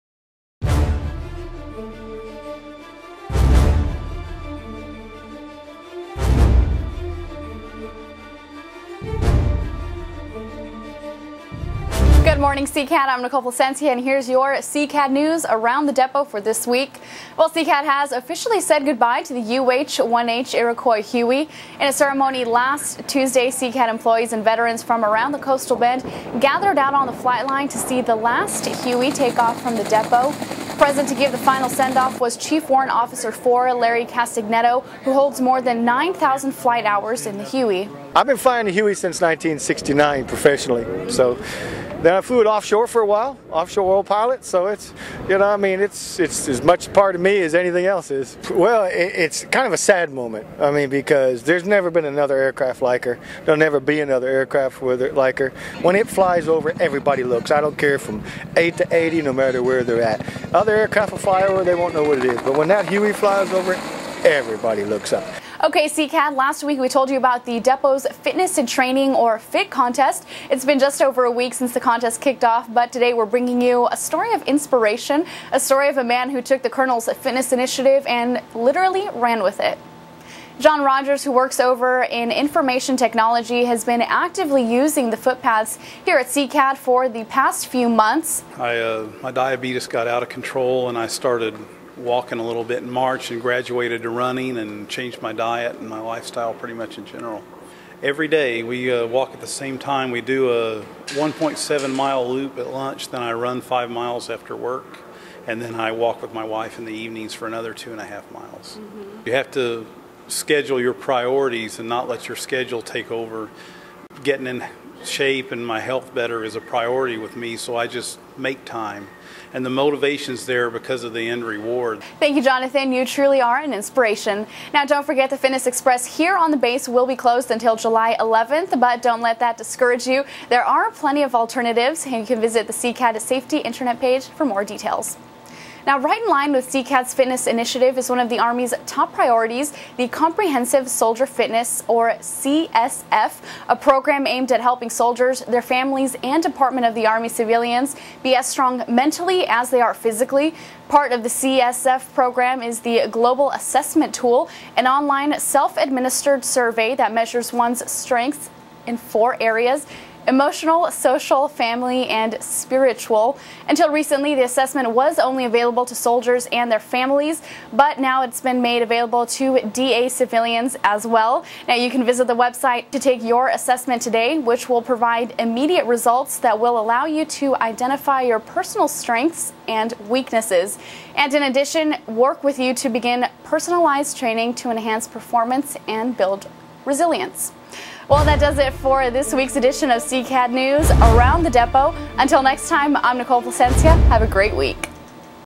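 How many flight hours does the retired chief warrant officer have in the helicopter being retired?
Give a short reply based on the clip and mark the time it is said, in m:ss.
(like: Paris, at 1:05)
more than 9,000, at 0:35.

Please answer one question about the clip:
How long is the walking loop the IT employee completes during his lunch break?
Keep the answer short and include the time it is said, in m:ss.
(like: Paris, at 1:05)
1.7 miles, at 1:41.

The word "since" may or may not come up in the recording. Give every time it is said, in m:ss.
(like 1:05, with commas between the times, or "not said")
0:38, 1:11.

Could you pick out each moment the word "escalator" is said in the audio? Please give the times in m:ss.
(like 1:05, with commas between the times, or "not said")
not said.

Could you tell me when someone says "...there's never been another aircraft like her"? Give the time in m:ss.
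0:51.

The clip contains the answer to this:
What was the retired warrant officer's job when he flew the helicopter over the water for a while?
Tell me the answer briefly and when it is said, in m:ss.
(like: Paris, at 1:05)
offshore oil pilot, at 0:43.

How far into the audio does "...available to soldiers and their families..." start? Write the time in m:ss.
2:45.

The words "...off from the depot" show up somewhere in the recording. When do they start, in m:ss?
0:29.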